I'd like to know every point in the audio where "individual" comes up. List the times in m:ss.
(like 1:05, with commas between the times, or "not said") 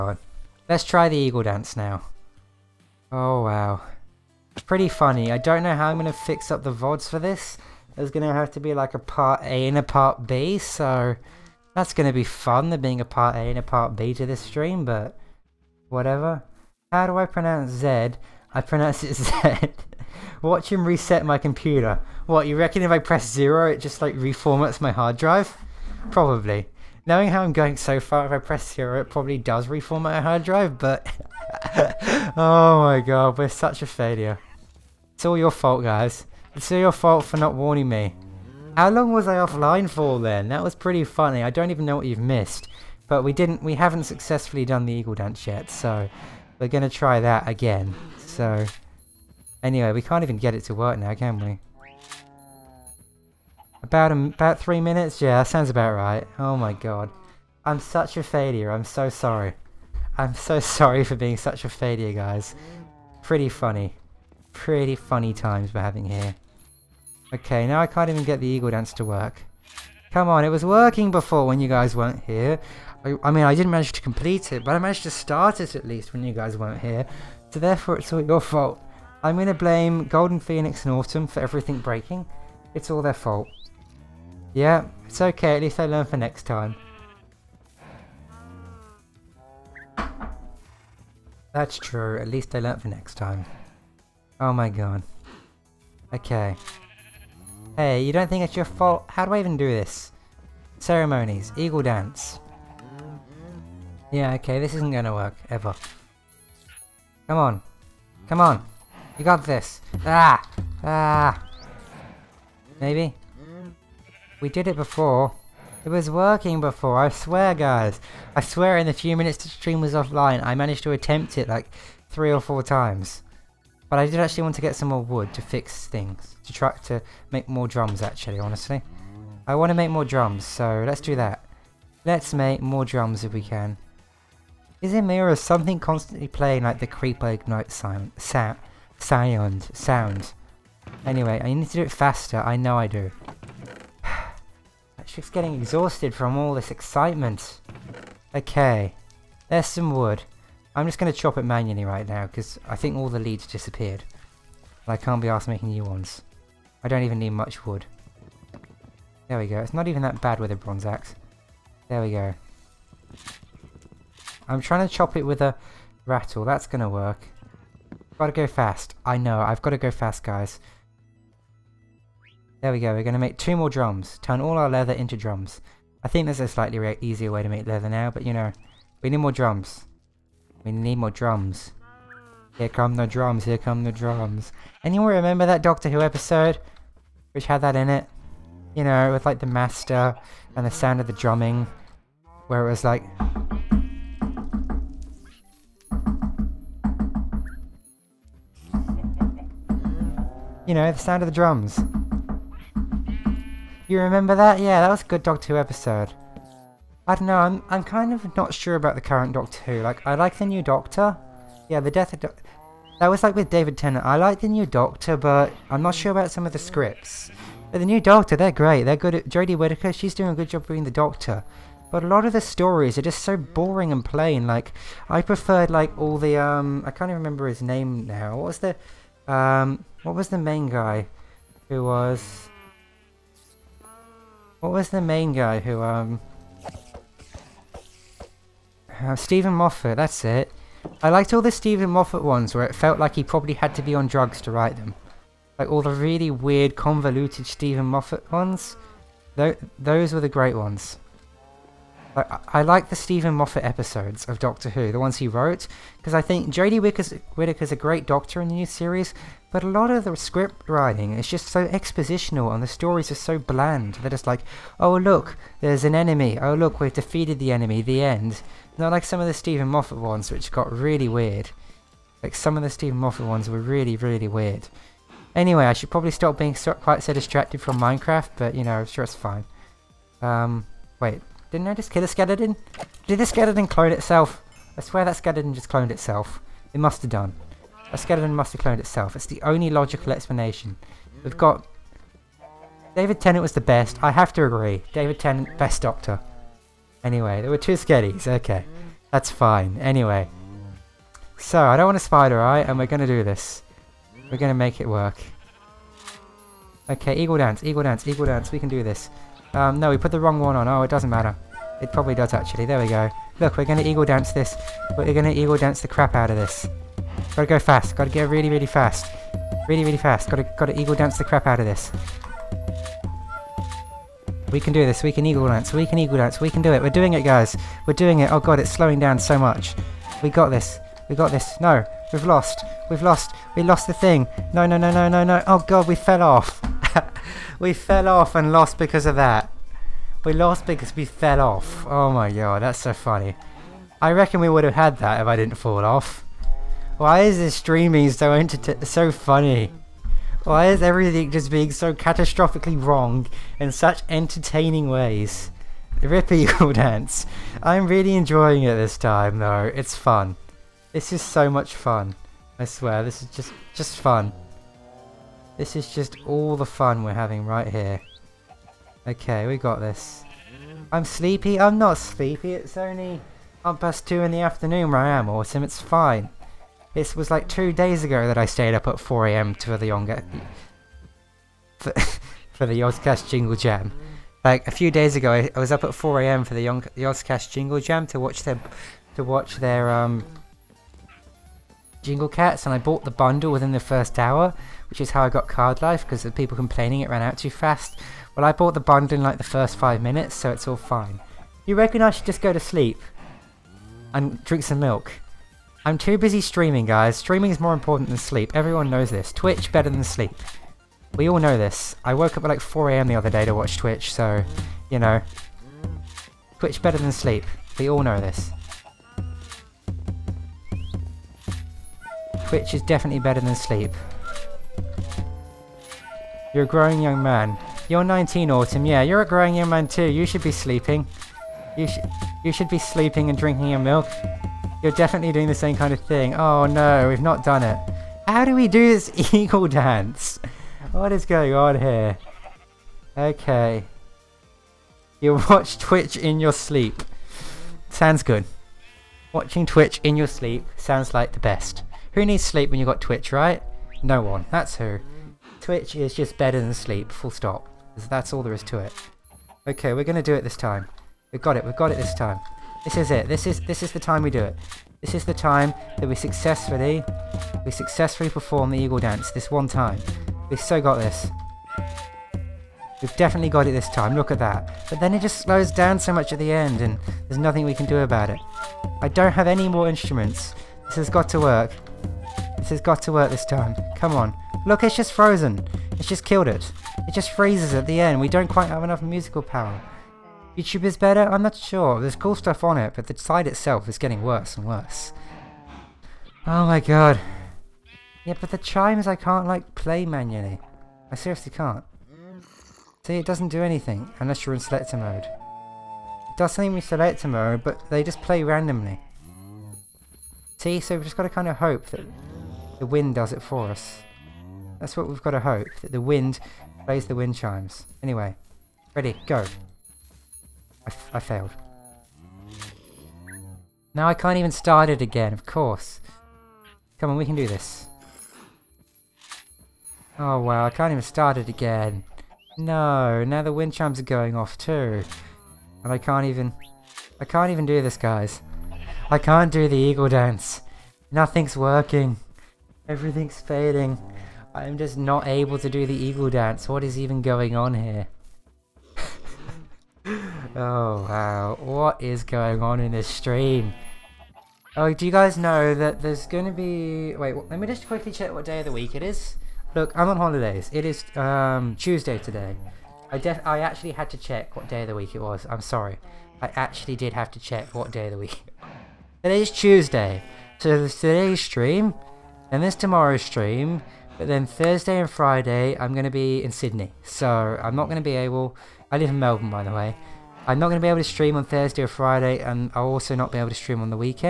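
not said.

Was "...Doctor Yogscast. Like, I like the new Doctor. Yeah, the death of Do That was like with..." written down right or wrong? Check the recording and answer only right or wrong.
wrong.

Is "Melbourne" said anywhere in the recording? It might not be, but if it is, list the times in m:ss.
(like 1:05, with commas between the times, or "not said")
9:39.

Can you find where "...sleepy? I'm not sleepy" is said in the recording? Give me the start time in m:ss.
6:11.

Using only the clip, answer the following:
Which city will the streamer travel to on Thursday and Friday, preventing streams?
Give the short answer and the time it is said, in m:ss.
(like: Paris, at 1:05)
Sydney, at 9:36.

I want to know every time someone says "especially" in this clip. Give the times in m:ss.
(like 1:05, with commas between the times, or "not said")
not said.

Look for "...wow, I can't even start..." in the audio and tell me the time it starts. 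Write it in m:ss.
8:50.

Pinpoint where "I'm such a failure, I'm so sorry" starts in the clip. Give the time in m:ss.
0:57.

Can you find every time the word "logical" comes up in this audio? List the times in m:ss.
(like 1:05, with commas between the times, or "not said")
4:49.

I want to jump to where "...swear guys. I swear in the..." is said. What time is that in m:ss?
1:57.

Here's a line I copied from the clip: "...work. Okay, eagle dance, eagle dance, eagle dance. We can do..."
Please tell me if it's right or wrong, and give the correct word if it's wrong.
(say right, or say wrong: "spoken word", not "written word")
right.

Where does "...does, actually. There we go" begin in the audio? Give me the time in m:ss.
5:12.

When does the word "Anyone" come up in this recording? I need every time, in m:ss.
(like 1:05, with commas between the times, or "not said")
3:04.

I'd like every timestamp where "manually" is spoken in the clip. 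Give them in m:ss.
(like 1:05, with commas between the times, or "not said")
2:31, 8:20.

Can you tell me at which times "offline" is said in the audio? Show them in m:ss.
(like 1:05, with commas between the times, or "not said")
0:39, 1:59.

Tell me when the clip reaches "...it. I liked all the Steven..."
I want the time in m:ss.
4:00.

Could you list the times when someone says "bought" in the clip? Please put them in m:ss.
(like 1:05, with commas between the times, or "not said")
6:32, 6:38.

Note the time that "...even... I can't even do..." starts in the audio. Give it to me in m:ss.
8:56.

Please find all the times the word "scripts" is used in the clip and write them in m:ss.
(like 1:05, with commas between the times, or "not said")
3:36, 4:20.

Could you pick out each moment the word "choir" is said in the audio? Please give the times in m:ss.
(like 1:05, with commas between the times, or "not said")
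not said.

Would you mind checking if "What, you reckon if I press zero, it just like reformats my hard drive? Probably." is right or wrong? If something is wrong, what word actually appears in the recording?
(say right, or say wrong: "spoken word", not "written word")
right.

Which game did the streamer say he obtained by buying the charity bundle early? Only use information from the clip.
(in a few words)
CardLife.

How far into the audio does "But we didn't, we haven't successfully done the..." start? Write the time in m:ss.
0:43.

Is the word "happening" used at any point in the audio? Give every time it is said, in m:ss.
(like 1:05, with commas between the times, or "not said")
not said.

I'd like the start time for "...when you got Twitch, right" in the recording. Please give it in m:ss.
7:32.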